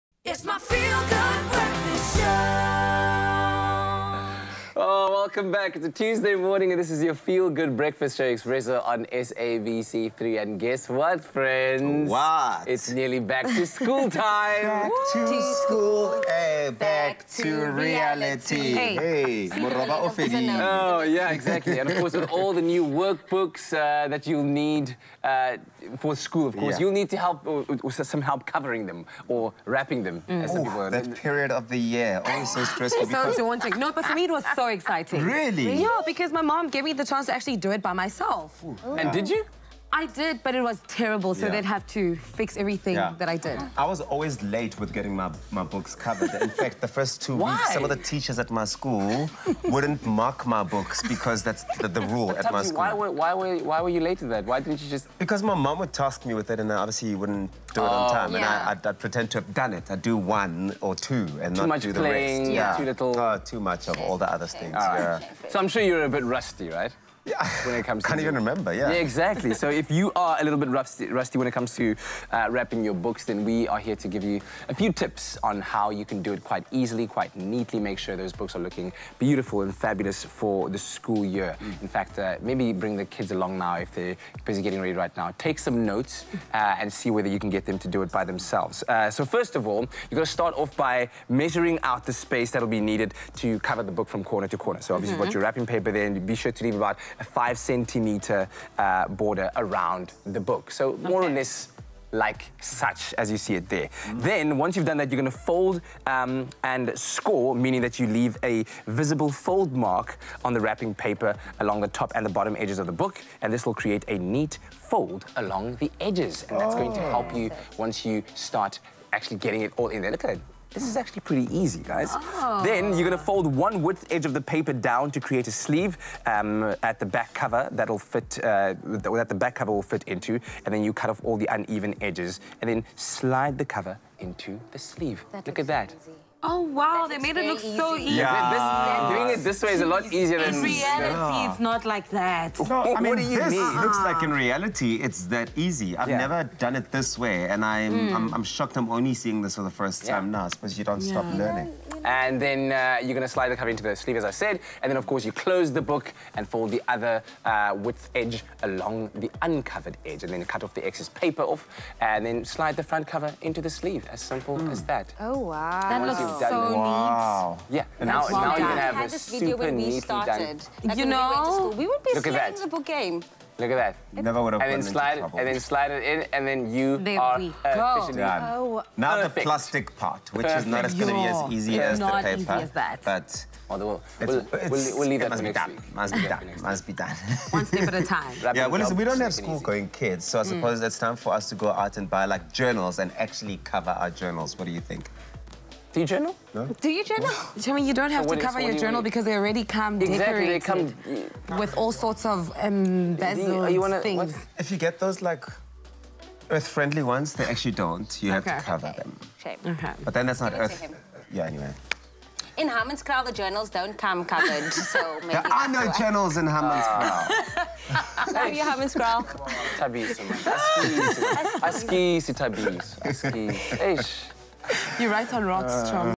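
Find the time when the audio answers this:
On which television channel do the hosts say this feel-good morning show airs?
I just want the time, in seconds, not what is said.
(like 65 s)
9 s.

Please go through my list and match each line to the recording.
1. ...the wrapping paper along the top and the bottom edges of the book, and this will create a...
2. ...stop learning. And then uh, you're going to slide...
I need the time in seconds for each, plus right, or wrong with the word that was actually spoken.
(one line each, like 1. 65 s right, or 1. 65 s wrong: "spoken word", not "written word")
1. 110 s right
2. 151 s right.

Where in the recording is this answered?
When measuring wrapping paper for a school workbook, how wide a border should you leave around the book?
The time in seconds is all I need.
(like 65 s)
97 s.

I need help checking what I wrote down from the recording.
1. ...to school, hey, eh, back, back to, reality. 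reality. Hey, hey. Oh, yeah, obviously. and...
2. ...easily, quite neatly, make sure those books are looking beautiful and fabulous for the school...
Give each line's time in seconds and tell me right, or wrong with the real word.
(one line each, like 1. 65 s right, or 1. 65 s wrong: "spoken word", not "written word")
1. 15 s wrong: "exactly", not "obviously"
2. 76 s right.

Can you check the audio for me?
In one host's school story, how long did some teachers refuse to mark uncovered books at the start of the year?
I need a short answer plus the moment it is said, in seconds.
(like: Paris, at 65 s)
first 2 weeks, at 46 s.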